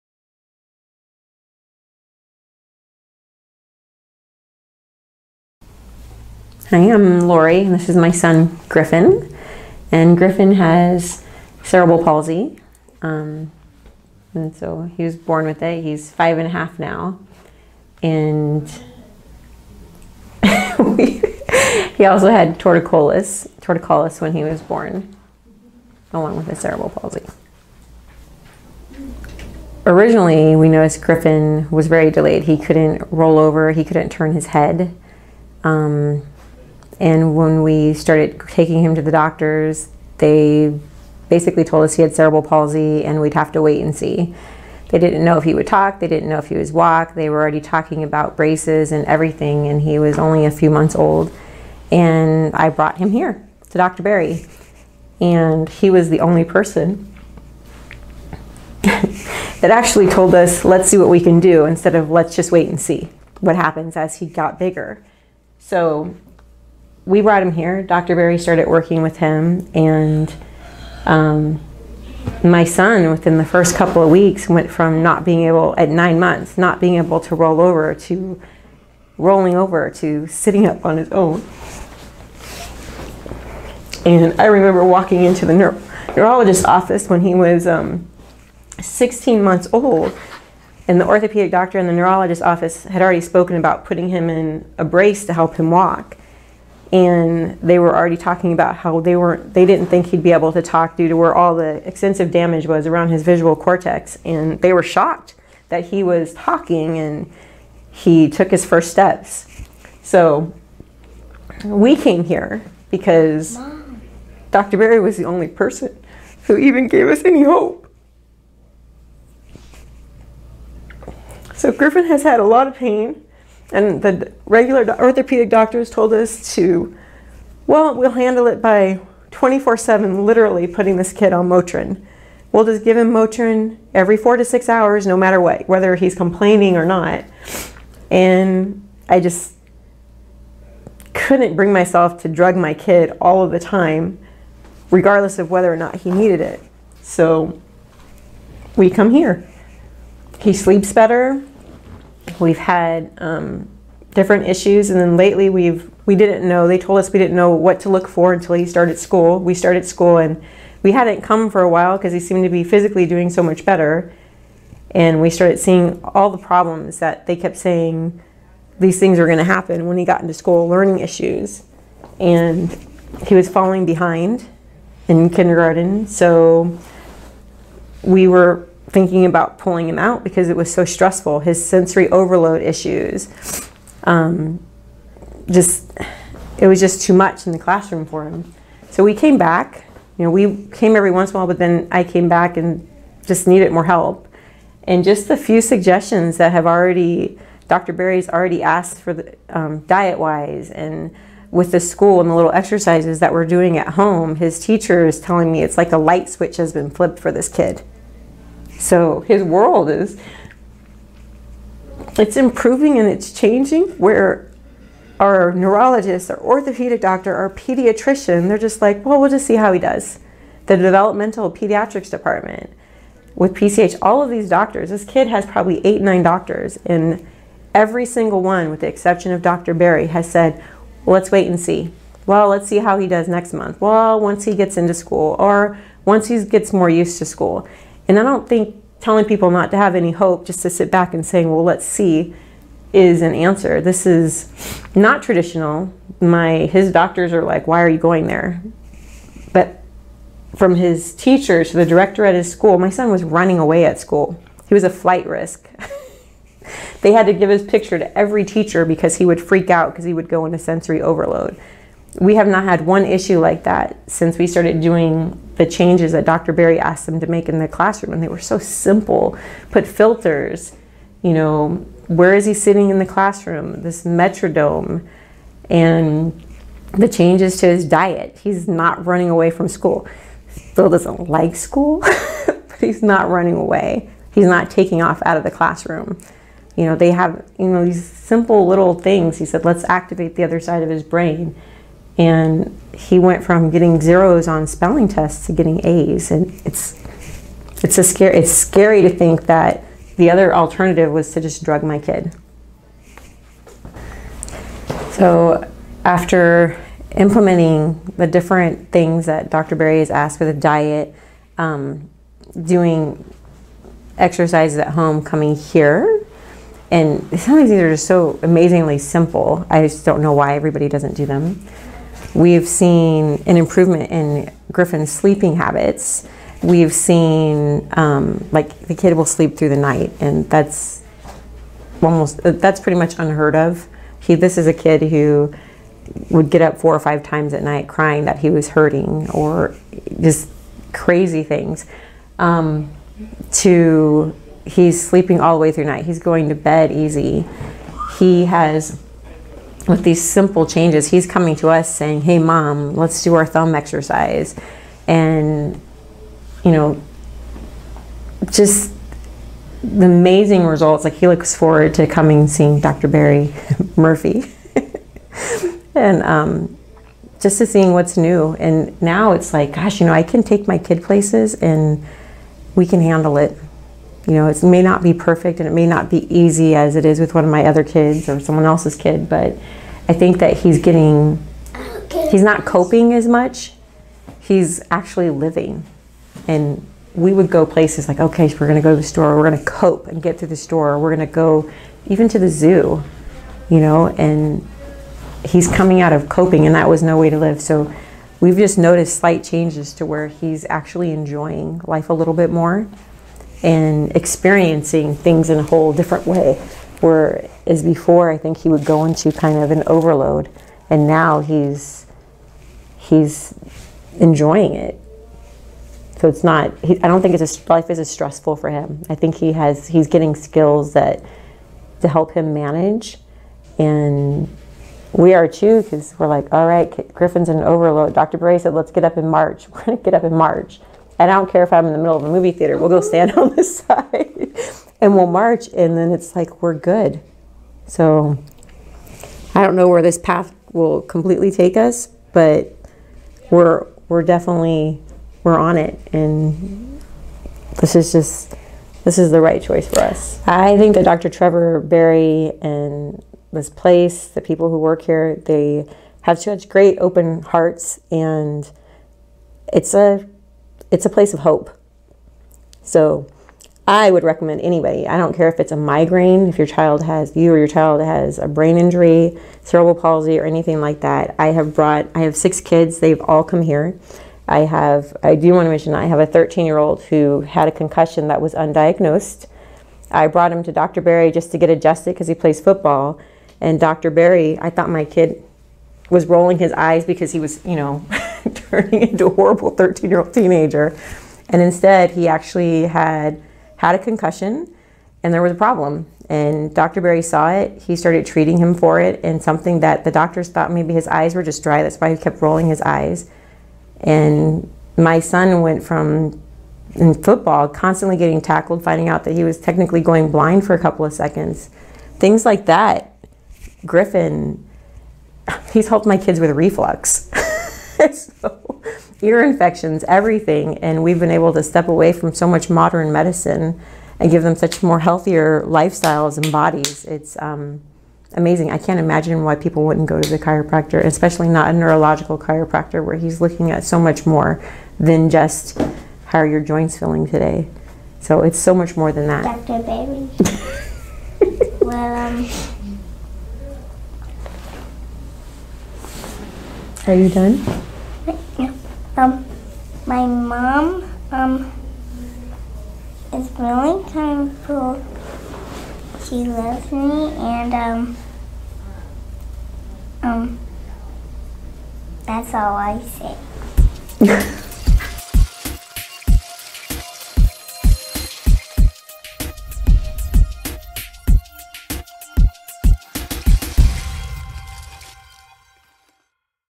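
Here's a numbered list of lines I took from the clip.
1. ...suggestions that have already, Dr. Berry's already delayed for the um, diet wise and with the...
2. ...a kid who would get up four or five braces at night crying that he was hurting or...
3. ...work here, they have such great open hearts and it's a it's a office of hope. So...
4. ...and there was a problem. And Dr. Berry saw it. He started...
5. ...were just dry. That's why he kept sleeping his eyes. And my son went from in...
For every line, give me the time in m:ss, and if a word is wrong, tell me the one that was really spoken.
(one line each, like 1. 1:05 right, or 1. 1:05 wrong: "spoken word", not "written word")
1. 3:15 wrong: "asked", not "delayed"
2. 5:34 wrong: "times", not "braces"
3. 7:34 wrong: "place", not "office"
4. 8:15 right
5. 8:21 wrong: "rolling", not "sleeping".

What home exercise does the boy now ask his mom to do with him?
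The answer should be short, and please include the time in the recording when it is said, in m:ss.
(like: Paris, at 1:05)
Thumb exercise, at 5:53.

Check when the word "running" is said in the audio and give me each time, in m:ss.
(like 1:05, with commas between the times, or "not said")
4:13, 4:39, 4:43.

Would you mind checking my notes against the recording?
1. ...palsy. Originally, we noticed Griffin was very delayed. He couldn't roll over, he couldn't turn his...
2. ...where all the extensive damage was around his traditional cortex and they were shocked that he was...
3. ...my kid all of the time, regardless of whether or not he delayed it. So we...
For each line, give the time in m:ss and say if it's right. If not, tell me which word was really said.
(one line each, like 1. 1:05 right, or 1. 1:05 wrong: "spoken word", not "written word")
1. 0:26 right
2. 1:41 wrong: "visual", not "traditional"
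3. 2:22 wrong: "needed", not "delayed".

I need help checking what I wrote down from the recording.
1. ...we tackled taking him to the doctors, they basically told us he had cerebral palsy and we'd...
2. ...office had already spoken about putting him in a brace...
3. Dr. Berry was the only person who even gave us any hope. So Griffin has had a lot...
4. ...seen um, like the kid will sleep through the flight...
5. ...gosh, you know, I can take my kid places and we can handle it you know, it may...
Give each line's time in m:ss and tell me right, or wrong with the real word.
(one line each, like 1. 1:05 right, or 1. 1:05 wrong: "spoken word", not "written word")
1. 0:37 wrong: "started", not "tackled"
2. 1:32 right
3. 1:54 right
4. 5:26 wrong: "night", not "flight"
5. 6:09 right.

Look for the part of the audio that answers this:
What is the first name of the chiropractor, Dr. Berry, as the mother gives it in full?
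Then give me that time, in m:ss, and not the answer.
7:31.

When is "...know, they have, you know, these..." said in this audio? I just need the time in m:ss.
4:46.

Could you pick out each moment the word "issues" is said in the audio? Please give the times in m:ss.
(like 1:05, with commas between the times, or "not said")
2:34, 2:50, 3:02, 4:23.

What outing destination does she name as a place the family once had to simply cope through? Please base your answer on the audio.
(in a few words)
The zoo.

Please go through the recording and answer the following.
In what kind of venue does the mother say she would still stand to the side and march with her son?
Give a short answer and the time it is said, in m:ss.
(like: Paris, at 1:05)
Movie theater, at 7:12.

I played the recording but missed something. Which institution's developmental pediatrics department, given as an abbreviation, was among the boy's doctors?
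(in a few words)
PCH.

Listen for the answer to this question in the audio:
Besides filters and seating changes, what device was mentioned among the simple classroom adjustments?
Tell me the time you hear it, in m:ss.
4:34.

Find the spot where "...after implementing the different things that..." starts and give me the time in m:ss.
5:06.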